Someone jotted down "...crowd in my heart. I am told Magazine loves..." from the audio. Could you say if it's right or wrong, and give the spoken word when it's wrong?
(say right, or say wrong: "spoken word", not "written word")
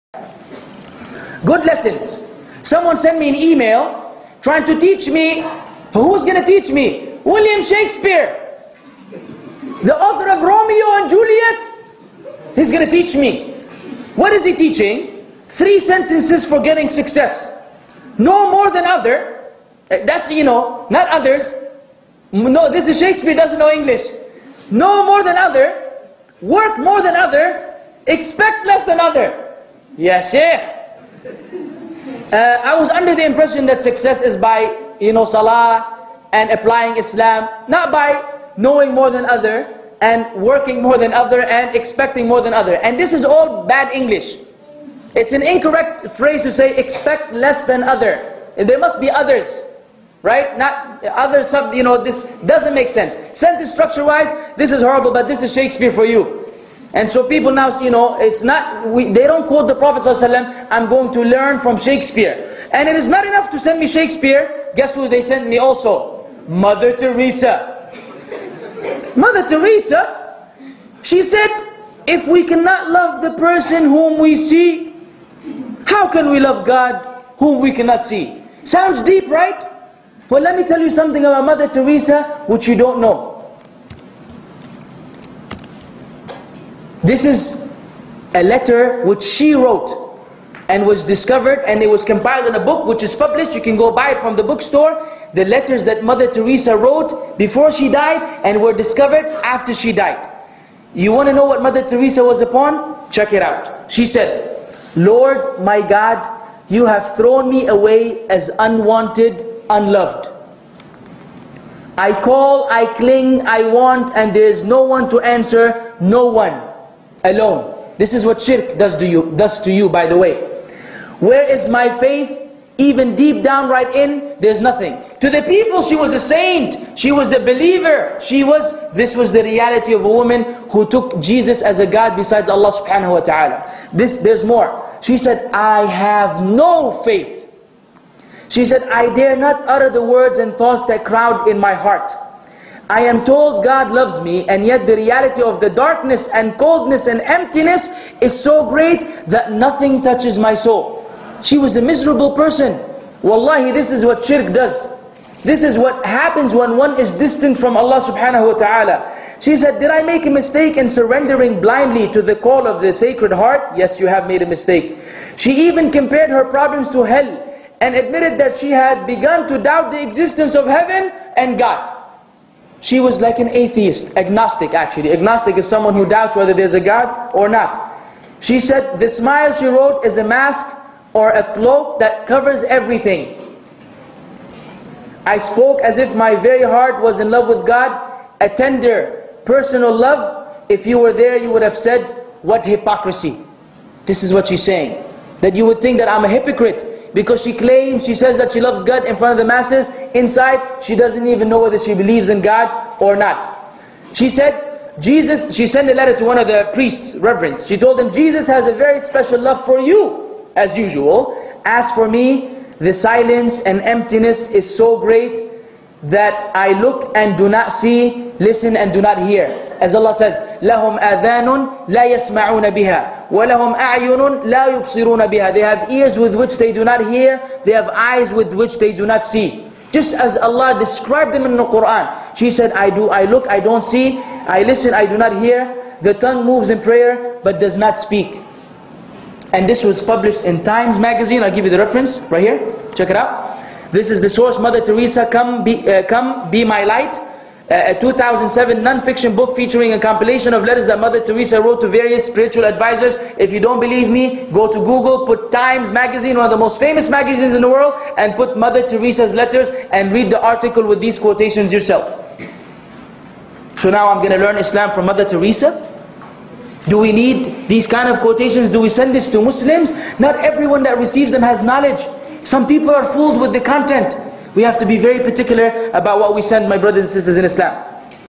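wrong: "God", not "Magazine".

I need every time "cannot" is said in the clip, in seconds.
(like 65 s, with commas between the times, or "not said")
72 s, 77 s.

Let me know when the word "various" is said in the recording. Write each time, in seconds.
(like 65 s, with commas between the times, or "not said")
251 s.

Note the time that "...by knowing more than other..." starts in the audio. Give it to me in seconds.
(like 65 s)
37 s.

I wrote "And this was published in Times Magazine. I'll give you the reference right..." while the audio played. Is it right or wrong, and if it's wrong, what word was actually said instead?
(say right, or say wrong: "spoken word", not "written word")
right.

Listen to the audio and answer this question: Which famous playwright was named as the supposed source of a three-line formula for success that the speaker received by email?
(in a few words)
William Shakespeare.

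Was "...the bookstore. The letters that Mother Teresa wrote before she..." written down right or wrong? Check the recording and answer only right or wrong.
right.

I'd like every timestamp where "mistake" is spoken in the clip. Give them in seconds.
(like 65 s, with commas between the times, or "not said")
160 s, 164 s.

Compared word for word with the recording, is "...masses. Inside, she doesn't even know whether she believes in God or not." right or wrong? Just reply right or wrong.
right.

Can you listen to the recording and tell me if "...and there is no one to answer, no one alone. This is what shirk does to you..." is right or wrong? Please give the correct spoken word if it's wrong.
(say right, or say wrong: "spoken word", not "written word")
right.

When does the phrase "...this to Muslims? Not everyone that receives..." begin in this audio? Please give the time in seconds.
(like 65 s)
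269 s.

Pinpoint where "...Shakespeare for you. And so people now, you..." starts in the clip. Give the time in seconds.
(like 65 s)
55 s.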